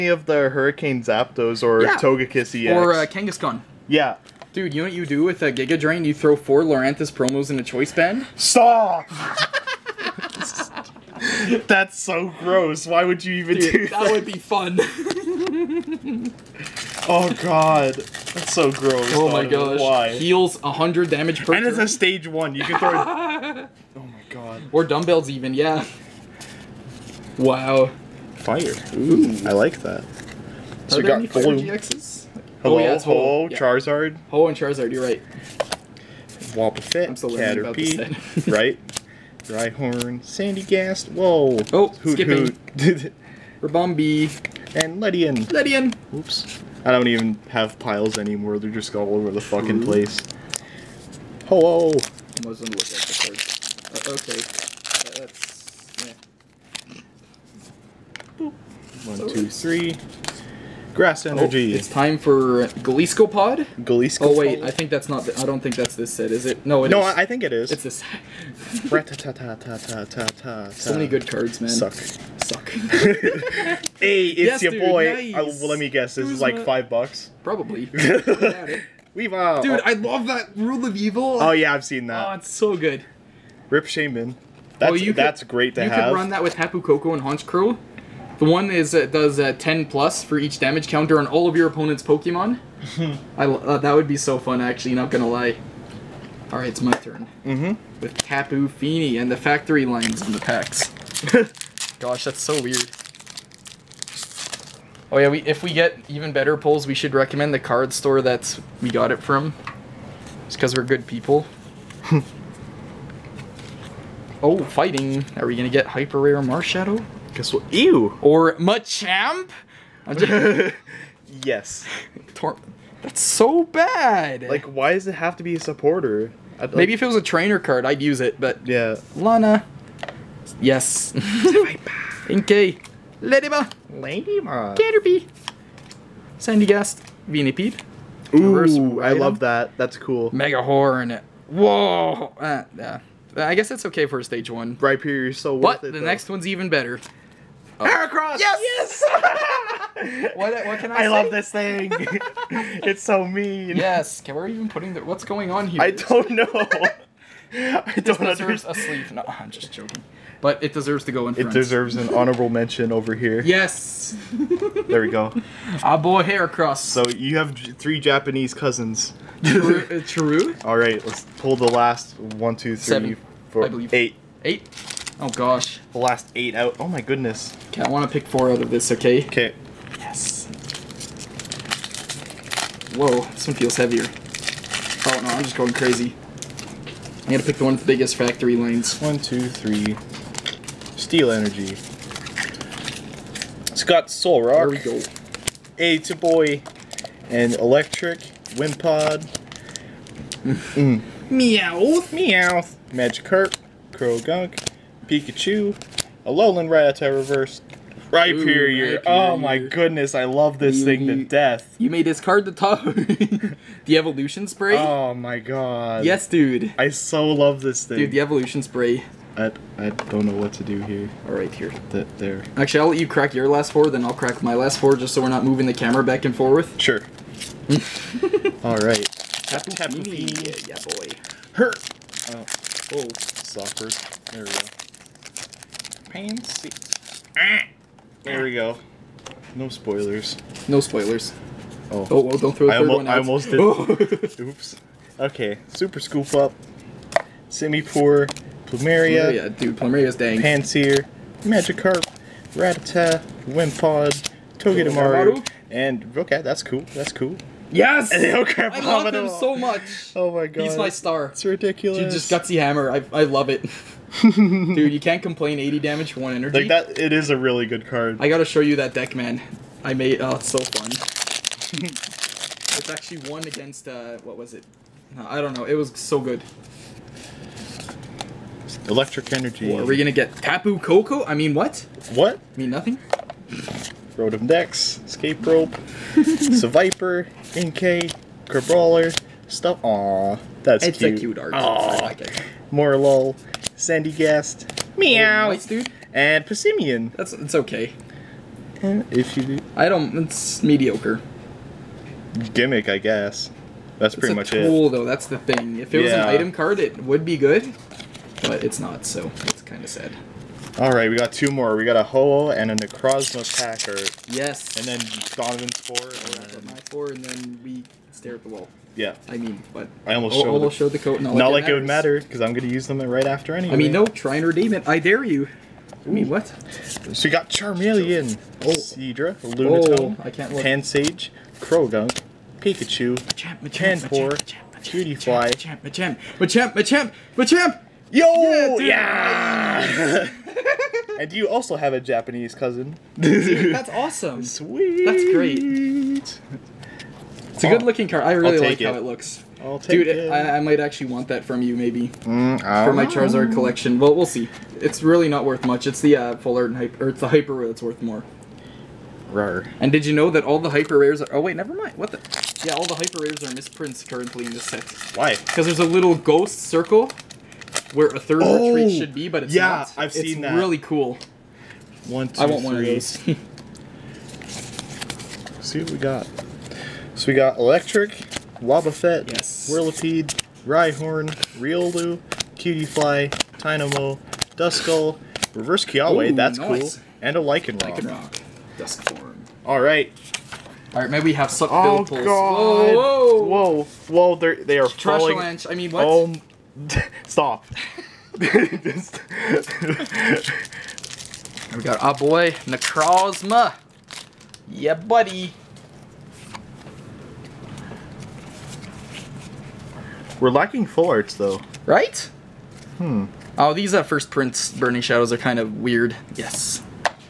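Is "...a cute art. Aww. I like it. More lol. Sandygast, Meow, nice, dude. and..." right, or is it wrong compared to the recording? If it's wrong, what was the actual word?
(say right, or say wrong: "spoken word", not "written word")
right.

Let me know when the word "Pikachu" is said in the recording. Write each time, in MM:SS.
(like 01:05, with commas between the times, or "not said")
03:25, 05:32.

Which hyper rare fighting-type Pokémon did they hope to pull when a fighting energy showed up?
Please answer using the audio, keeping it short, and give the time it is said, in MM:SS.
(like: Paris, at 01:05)
Marshadow, at 01:55.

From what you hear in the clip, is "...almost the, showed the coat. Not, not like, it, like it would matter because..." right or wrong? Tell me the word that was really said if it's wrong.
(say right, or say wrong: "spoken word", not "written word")
right.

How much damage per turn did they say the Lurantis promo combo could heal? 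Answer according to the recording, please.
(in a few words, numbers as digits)
100.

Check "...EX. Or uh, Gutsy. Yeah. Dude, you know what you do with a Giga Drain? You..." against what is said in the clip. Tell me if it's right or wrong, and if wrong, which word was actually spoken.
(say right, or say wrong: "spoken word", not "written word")
wrong: "Kangaskhan", not "Gutsy".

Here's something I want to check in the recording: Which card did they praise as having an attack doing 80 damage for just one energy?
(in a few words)
Gutsy Hammer.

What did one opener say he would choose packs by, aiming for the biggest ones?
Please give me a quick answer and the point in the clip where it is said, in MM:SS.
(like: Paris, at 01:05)
Factory lines, at 03:08.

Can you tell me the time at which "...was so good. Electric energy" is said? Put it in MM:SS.
04:35.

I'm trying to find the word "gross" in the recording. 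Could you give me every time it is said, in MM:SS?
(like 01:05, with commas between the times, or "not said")
00:12, 00:18.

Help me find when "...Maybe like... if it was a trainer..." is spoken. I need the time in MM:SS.
02:06.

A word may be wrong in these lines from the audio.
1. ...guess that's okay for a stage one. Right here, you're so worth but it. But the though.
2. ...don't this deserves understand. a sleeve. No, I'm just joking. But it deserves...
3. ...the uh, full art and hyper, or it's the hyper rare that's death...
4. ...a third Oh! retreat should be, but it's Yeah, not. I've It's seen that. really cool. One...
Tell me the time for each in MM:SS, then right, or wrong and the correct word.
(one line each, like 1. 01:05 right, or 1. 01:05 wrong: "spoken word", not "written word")
1. 02:23 right
2. 02:37 right
3. 05:55 wrong: "worth", not "death"
4. 06:08 right.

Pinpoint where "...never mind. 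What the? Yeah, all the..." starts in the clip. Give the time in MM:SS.
06:01.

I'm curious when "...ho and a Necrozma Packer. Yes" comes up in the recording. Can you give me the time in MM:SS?
05:12.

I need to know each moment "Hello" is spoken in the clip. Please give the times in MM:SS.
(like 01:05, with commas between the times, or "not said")
00:32, 00:51.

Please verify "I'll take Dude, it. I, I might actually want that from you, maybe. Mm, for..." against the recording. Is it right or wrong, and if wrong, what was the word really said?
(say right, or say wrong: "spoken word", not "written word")
right.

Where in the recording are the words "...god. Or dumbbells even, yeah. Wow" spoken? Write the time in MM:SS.
00:24.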